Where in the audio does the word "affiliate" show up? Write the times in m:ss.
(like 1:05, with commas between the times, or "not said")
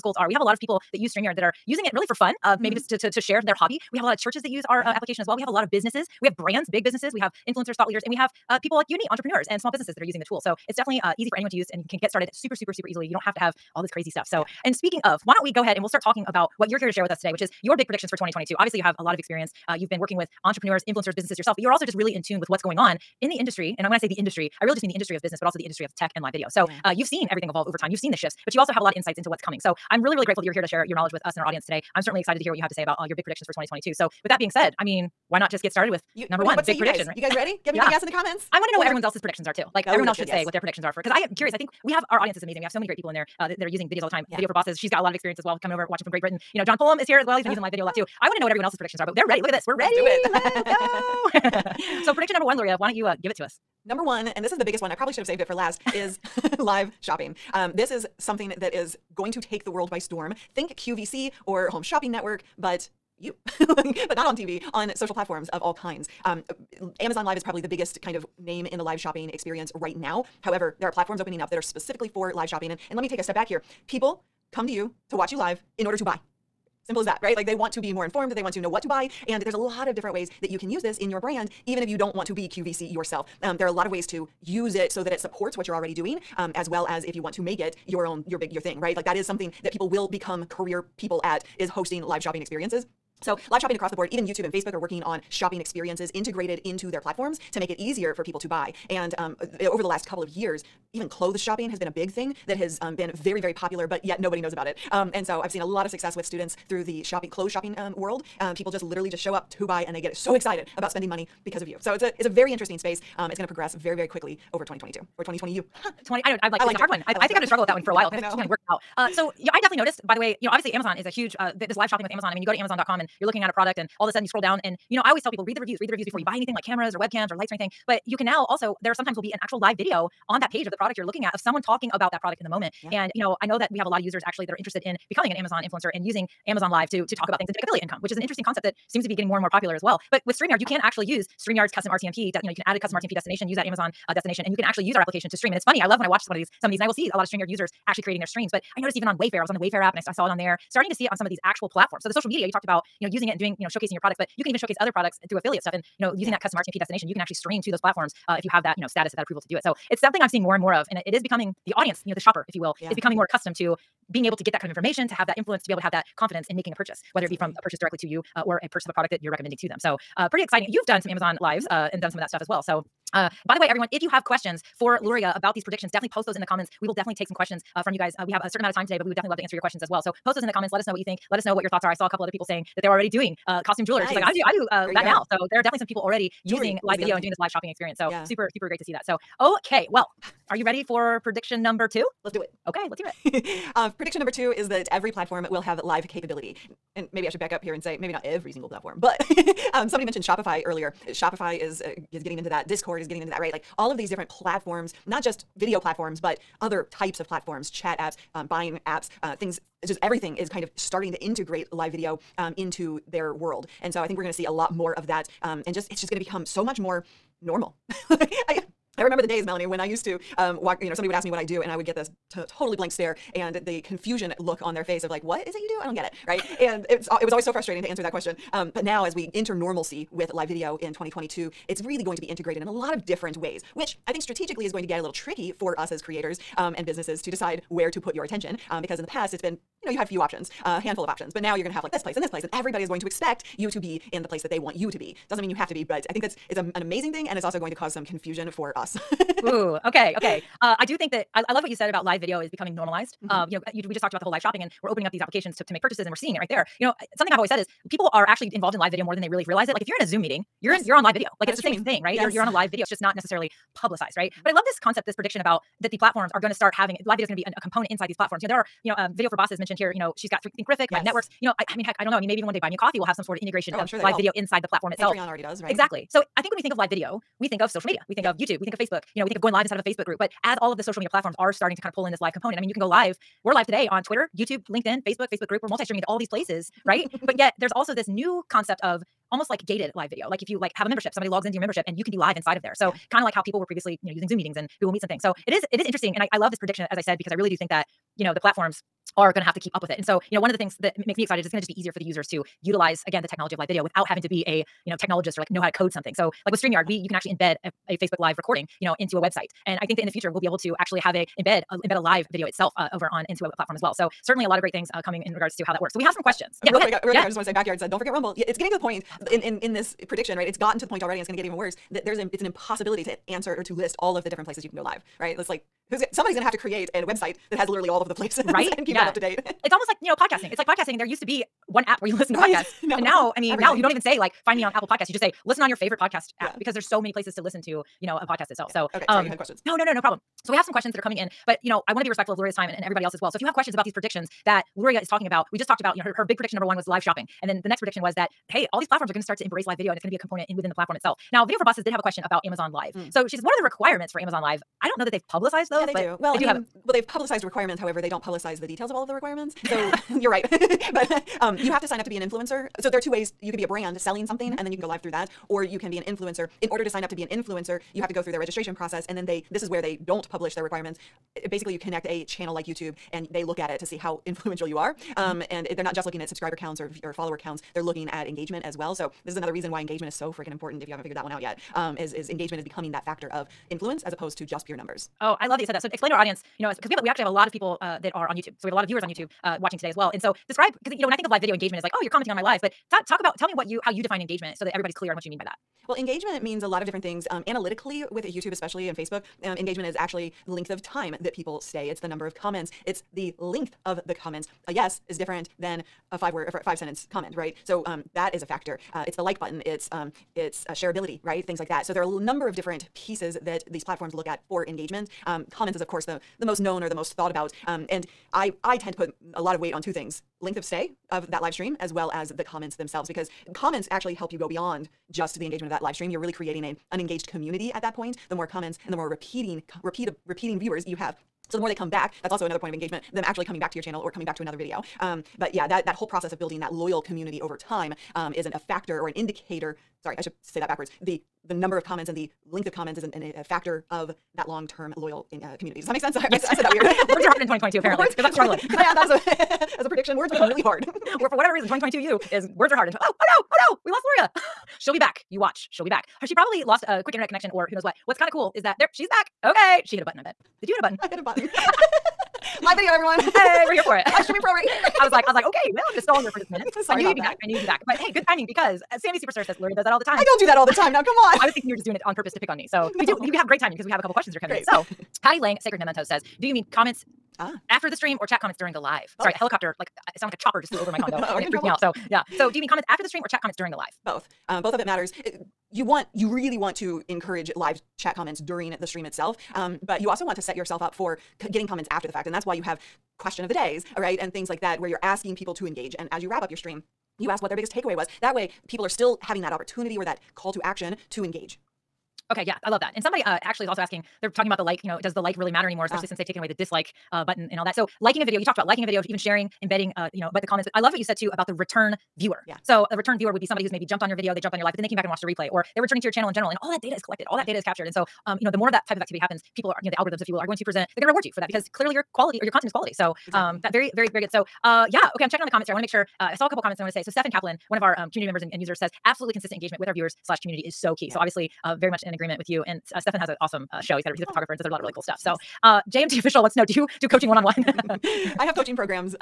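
2:17, 2:35.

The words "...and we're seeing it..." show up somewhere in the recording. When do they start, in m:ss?
4:16.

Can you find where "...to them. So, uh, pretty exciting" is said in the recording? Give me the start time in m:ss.
2:49.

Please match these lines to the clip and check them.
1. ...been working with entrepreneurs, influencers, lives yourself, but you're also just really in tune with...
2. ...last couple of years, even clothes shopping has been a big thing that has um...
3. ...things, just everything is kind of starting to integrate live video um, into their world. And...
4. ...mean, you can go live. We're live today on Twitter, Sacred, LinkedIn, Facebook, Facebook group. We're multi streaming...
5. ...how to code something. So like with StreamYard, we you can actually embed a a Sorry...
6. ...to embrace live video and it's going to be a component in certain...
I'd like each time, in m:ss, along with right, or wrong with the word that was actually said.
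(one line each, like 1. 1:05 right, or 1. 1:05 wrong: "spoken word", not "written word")
1. 0:19 wrong: "businesses", not "lives"
2. 1:39 right
3. 3:29 right
4. 4:42 wrong: "YouTube", not "Sacred"
5. 5:05 wrong: "Facebook", not "Sorry"
6. 5:49 wrong: "within", not "certain".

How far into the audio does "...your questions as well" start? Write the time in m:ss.
2:59.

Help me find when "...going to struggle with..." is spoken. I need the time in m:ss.
1:57.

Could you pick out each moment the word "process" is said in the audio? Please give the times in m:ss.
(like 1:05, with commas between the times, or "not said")
6:08, 7:16.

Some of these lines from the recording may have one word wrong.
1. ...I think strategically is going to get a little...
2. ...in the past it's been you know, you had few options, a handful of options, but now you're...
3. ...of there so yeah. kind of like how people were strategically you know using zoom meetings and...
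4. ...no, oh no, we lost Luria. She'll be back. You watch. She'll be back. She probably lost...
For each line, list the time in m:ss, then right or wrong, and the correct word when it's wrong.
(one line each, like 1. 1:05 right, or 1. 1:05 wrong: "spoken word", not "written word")
1. 3:54 right
2. 3:58 right
3. 4:52 wrong: "previously", not "strategically"
4. 7:33 right.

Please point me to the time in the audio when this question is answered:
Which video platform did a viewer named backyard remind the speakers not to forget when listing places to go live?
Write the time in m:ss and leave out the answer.
5:17.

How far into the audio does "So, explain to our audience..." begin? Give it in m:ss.
6:25.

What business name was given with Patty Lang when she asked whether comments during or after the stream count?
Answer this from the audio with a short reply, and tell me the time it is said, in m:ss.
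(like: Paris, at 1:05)
Sacred Mementos, at 7:55.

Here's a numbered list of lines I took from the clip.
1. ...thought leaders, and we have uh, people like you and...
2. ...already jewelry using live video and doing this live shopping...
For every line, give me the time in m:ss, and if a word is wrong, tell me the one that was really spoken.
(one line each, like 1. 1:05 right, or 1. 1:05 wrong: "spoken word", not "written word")
1. 0:07 right
2. 3:06 right.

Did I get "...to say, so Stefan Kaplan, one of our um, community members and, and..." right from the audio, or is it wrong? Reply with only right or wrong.
right.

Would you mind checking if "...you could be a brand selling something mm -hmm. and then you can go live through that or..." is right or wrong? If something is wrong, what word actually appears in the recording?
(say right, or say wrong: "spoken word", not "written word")
right.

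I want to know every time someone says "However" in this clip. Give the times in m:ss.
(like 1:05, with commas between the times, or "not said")
1:10, 5:57.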